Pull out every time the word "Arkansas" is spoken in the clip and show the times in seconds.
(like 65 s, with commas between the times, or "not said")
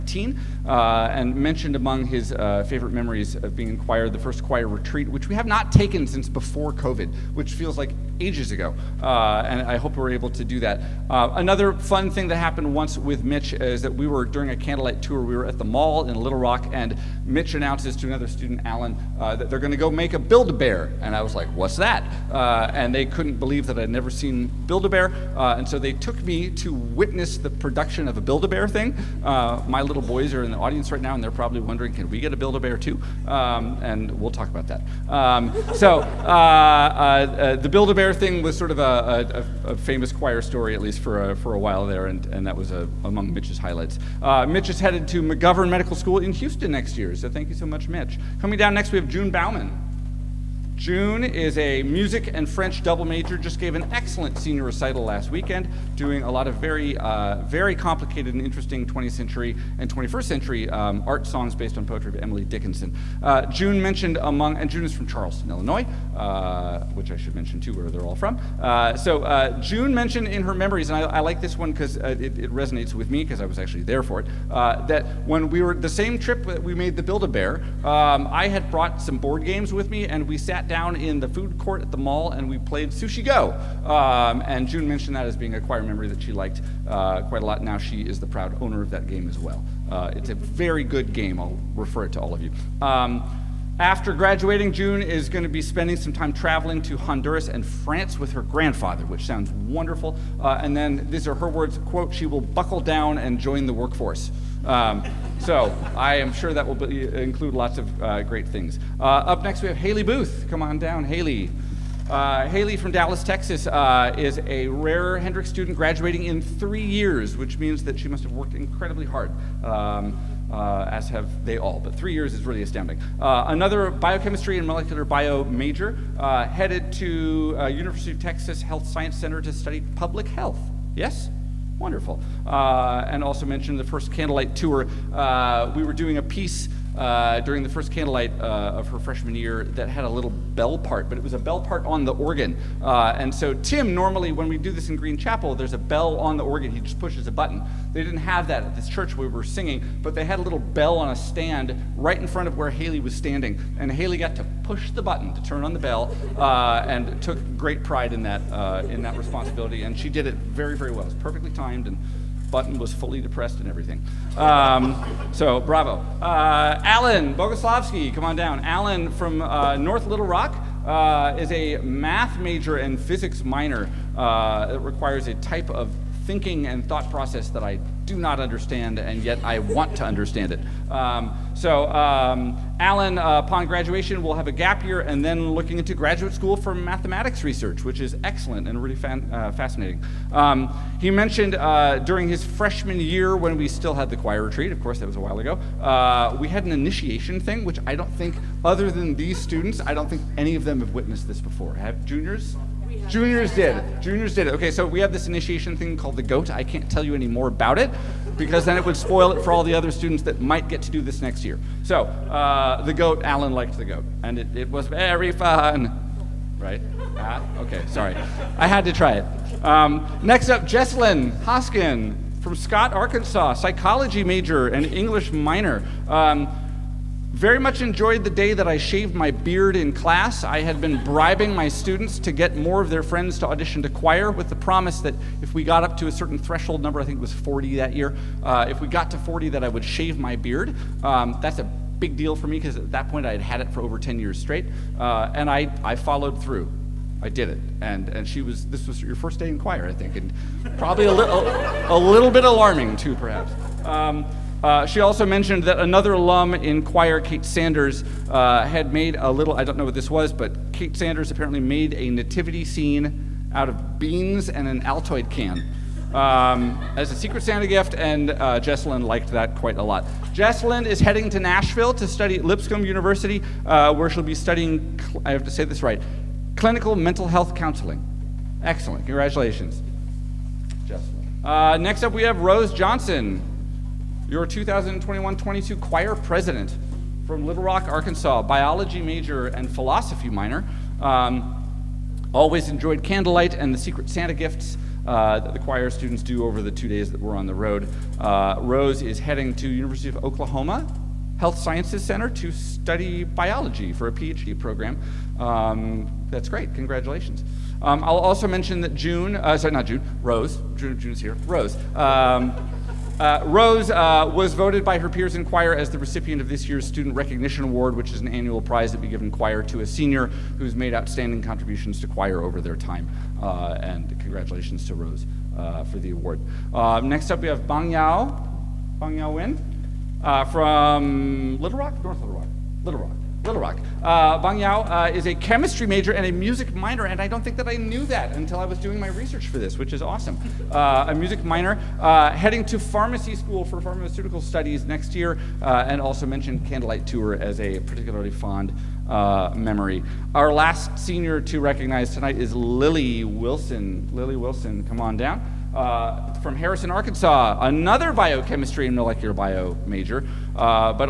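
222 s, 287 s, 356 s.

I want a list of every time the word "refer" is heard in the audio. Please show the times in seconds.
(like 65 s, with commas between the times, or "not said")
91 s.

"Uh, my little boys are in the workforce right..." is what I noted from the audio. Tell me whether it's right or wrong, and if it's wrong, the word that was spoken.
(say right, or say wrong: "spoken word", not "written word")
wrong: "audience", not "workforce".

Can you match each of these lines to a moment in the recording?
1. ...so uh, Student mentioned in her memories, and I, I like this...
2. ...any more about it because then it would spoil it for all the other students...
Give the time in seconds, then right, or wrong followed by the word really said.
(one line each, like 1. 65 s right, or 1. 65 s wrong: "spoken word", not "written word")
1. 68 s wrong: "June", not "Student"
2. 207 s right.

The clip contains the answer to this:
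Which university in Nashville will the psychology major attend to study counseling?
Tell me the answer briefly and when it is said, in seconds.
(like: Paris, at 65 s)
Lipscomb University, at 272 s.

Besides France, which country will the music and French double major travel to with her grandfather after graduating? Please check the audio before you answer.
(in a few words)
Honduras.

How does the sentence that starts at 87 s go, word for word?
Now she is the proud owner of that game as well.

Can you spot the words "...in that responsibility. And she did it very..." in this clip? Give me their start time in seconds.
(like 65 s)
158 s.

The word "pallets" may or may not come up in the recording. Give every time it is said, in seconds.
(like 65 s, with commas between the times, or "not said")
not said.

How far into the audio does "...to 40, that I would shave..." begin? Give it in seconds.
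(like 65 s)
239 s.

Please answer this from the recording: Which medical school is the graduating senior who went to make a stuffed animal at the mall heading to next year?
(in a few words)
McGovern Medical School.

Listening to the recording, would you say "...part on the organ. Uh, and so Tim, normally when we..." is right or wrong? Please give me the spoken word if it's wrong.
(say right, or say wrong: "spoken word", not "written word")
right.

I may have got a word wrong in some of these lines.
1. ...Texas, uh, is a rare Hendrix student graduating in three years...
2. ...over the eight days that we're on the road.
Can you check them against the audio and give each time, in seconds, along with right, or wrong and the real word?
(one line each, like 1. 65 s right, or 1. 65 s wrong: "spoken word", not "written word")
1. 113 s right
2. 296 s wrong: "two", not "eight".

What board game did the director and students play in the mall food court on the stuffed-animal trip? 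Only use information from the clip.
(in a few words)
Sushi Go.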